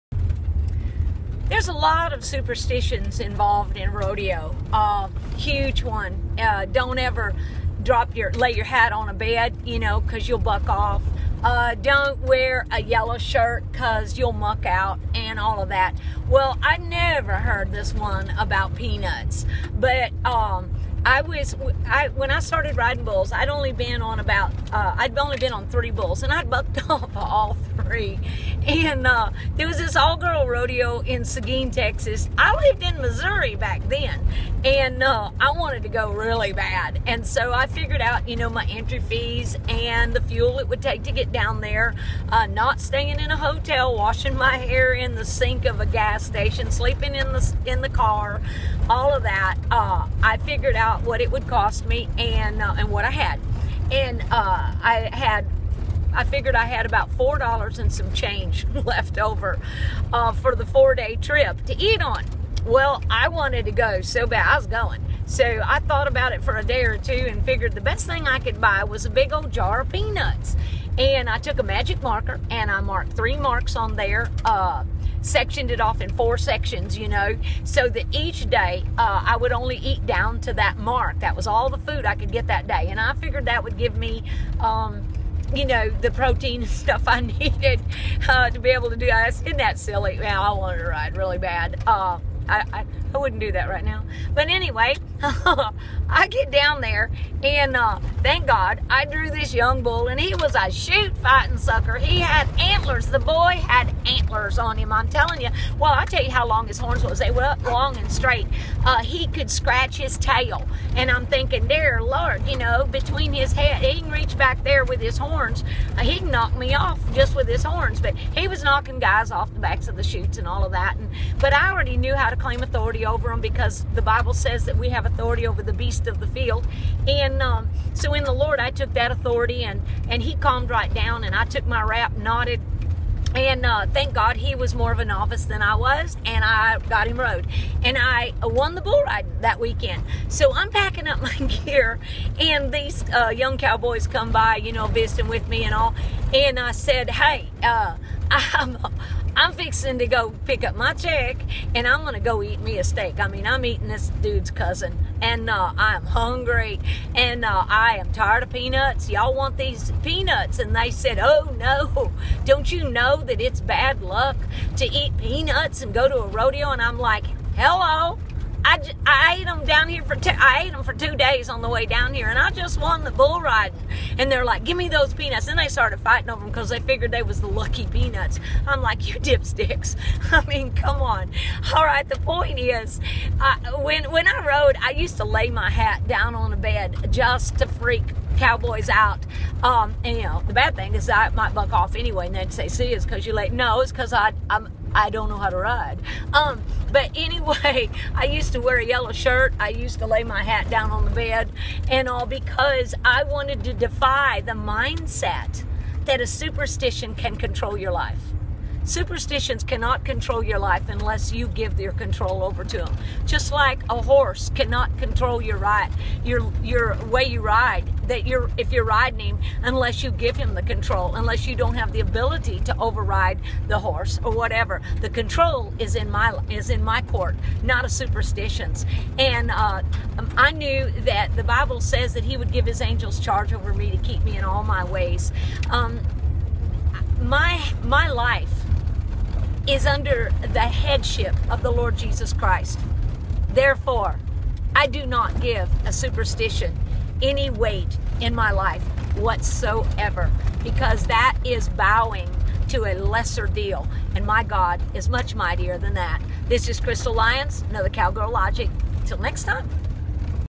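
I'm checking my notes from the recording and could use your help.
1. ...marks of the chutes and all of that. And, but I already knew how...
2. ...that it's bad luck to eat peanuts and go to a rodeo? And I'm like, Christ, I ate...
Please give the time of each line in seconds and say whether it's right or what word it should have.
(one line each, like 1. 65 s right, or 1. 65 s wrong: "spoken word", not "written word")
1. 119 s wrong: "backs", not "marks"
2. 163 s wrong: "Hello", not "Christ".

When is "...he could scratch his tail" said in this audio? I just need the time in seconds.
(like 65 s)
109 s.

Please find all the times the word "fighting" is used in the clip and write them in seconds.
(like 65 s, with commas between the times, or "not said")
101 s, 175 s.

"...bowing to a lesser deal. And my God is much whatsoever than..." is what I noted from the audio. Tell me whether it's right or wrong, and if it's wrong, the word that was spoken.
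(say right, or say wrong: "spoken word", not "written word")
wrong: "mightier", not "whatsoever".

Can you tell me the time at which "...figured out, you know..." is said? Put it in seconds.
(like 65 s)
37 s.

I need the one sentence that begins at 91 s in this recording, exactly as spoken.
Uh, I, I, I wouldn't do that right now.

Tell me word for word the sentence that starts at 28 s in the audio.
And uh, there was this all-girl rodeo in Seguin, Texas.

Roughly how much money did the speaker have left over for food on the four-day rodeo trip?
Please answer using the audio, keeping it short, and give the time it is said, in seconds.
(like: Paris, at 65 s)
$4, at 57 s.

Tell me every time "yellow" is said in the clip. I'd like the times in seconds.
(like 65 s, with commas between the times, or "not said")
12 s, 198 s.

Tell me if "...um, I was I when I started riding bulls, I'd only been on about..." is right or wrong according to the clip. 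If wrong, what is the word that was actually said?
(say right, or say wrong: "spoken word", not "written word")
right.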